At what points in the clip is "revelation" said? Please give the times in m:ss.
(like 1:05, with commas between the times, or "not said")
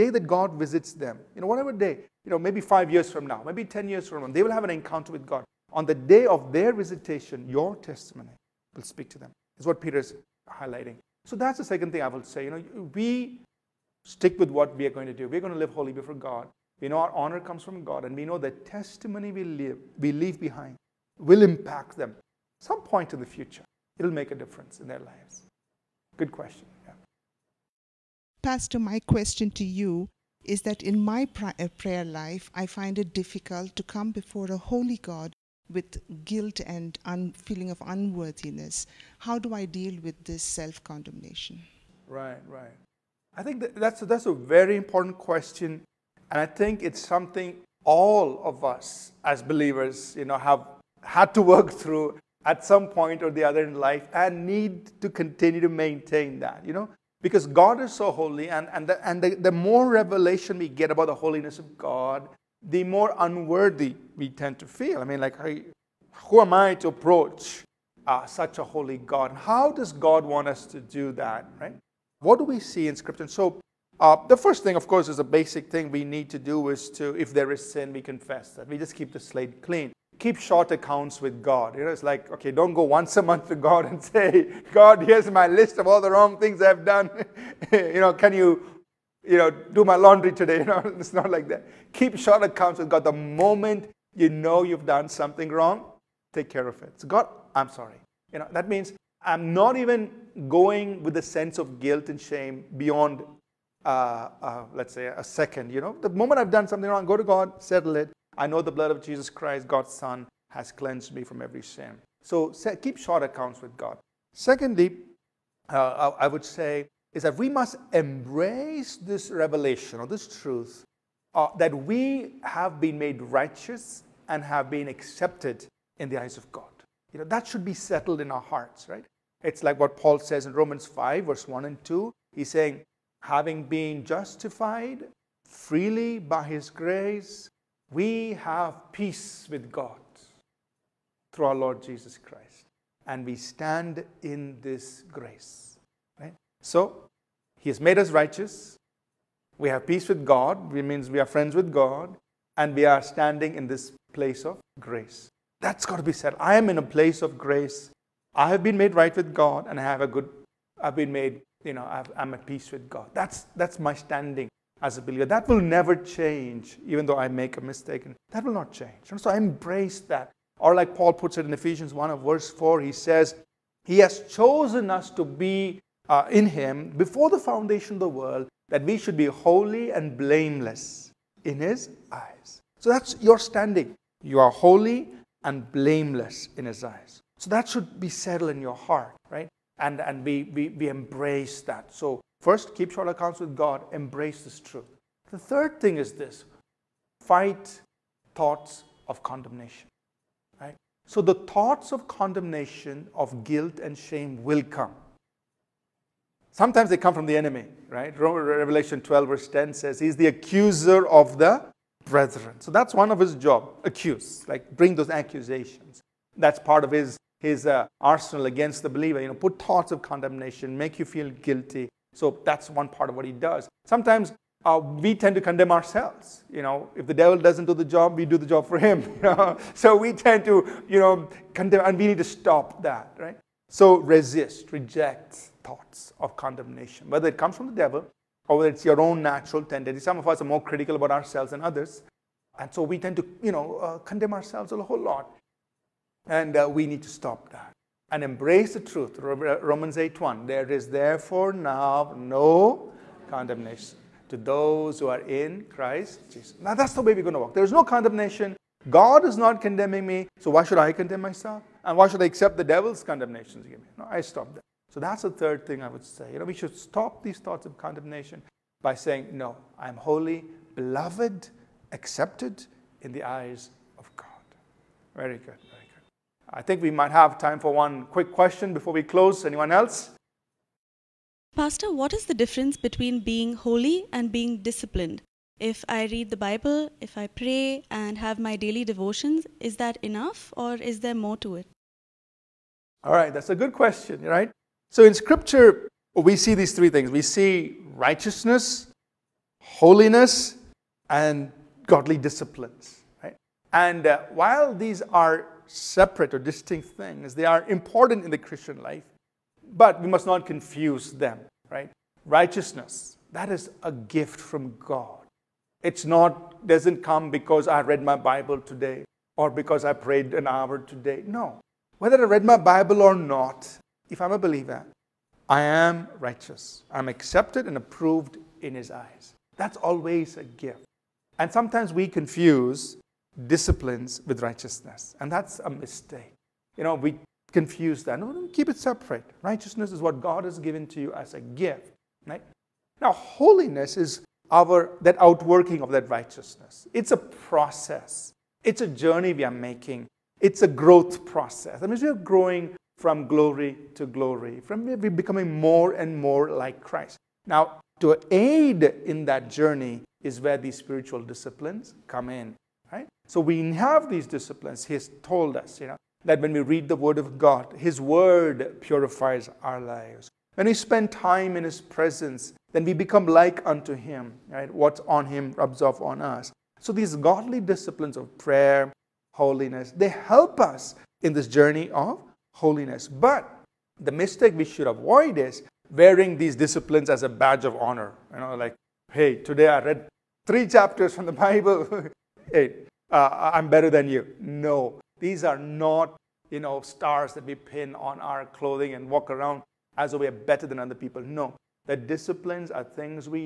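0:59, 1:59, 3:28.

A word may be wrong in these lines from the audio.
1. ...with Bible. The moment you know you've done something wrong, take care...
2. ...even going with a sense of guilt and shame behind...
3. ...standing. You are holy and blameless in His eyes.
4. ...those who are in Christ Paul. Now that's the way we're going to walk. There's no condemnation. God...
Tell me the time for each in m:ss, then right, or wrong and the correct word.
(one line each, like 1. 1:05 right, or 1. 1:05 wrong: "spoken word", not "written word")
1. 1:32 wrong: "God", not "Bible"
2. 1:39 wrong: "beyond", not "behind"
3. 3:03 right
4. 4:14 wrong: "Jesus", not "Paul".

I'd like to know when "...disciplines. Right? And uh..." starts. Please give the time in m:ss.
5:02.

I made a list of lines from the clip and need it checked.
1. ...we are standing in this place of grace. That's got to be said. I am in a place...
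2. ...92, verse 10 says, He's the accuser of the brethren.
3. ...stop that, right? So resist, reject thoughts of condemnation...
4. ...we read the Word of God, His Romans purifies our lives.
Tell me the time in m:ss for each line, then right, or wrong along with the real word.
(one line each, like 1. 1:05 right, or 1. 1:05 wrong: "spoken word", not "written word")
1. 2:32 right
2. 3:29 wrong: "12", not "92"
3. 3:52 right
4. 6:06 wrong: "Word", not "Romans".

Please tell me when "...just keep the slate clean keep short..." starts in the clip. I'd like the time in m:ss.
1:18.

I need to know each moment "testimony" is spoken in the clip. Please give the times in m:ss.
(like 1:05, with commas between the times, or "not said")
0:07, 0:18.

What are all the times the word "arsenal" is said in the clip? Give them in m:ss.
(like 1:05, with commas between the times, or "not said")
3:37.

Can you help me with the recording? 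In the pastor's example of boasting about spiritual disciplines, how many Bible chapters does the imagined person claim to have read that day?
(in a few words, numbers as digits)
3.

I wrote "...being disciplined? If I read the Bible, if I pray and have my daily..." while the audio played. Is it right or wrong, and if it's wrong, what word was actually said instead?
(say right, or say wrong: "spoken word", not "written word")
right.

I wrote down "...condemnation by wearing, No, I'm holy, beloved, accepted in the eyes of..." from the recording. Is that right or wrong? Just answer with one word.
wrong.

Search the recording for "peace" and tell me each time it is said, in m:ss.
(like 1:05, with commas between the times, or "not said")
2:18, 2:29, 2:42.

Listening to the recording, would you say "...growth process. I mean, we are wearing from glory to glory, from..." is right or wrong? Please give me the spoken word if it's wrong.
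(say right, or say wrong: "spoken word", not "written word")
wrong: "growing", not "wearing".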